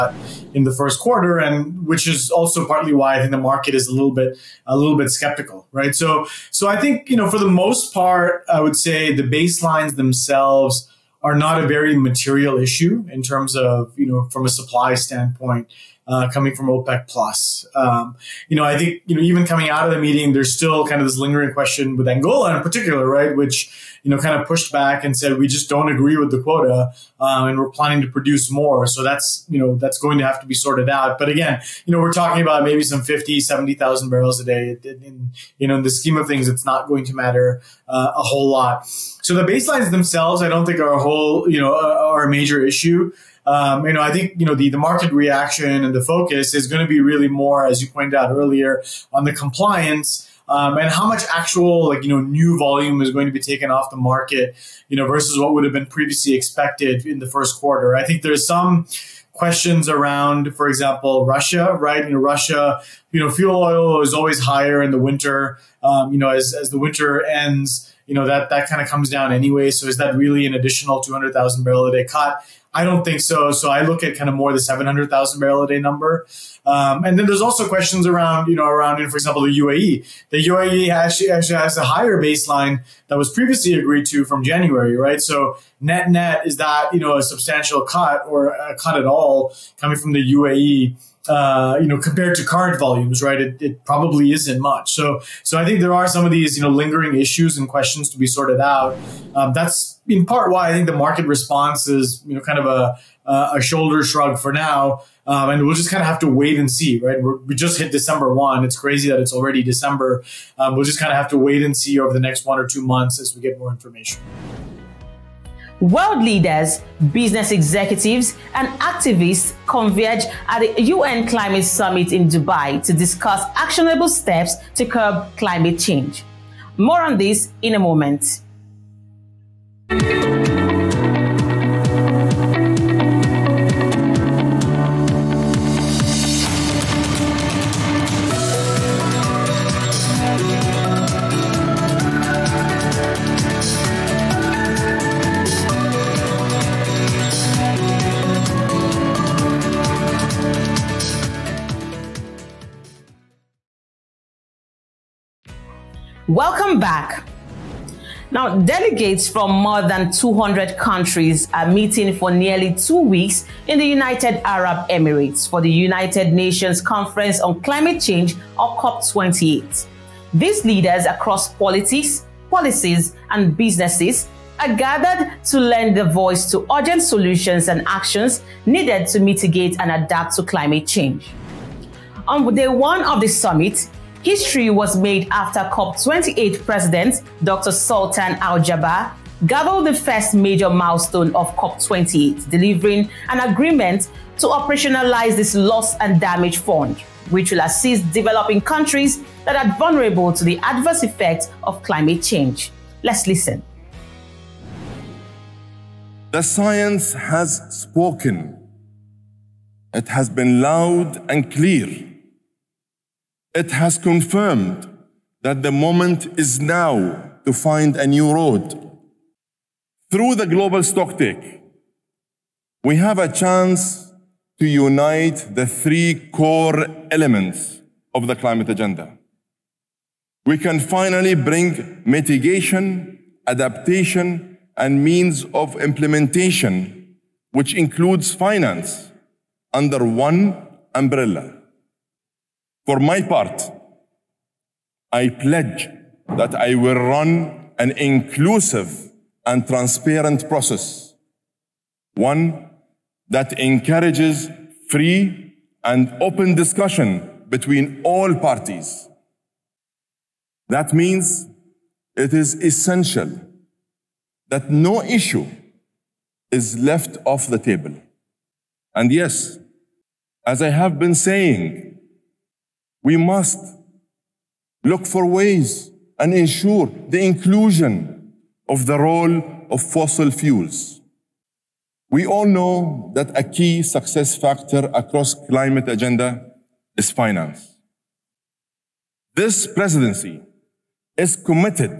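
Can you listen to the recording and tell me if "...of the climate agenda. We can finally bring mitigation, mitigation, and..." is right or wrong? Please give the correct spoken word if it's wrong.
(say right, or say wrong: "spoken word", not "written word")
wrong: "adaptation", not "mitigation".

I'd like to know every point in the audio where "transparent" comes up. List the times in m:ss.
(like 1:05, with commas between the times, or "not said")
4:09.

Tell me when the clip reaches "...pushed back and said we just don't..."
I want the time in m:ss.
0:24.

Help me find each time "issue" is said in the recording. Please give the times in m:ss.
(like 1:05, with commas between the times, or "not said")
0:12, 0:42, 1:37, 4:25.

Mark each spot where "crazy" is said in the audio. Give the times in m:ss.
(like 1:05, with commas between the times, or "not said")
1:48.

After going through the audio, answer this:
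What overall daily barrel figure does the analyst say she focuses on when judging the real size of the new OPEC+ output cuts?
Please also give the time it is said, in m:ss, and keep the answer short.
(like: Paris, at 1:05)
700,000 barrels a day, at 1:14.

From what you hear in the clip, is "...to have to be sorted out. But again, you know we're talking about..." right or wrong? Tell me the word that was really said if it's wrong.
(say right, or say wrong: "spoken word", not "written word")
right.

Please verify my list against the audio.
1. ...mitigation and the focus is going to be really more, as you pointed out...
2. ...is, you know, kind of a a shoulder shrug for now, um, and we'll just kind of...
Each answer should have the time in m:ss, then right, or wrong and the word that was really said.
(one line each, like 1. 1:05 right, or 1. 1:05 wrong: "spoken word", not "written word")
1. 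0:45 wrong: "reaction", not "mitigation"
2. 1:41 right.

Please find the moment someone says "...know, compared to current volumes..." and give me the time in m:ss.
1:31.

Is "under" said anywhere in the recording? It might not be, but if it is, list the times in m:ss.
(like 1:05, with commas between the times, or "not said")
3:59.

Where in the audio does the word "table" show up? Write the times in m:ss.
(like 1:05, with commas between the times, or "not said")
4:27.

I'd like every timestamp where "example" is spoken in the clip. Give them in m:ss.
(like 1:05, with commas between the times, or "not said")
1:00, 1:19.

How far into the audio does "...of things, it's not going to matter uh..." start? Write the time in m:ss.
0:36.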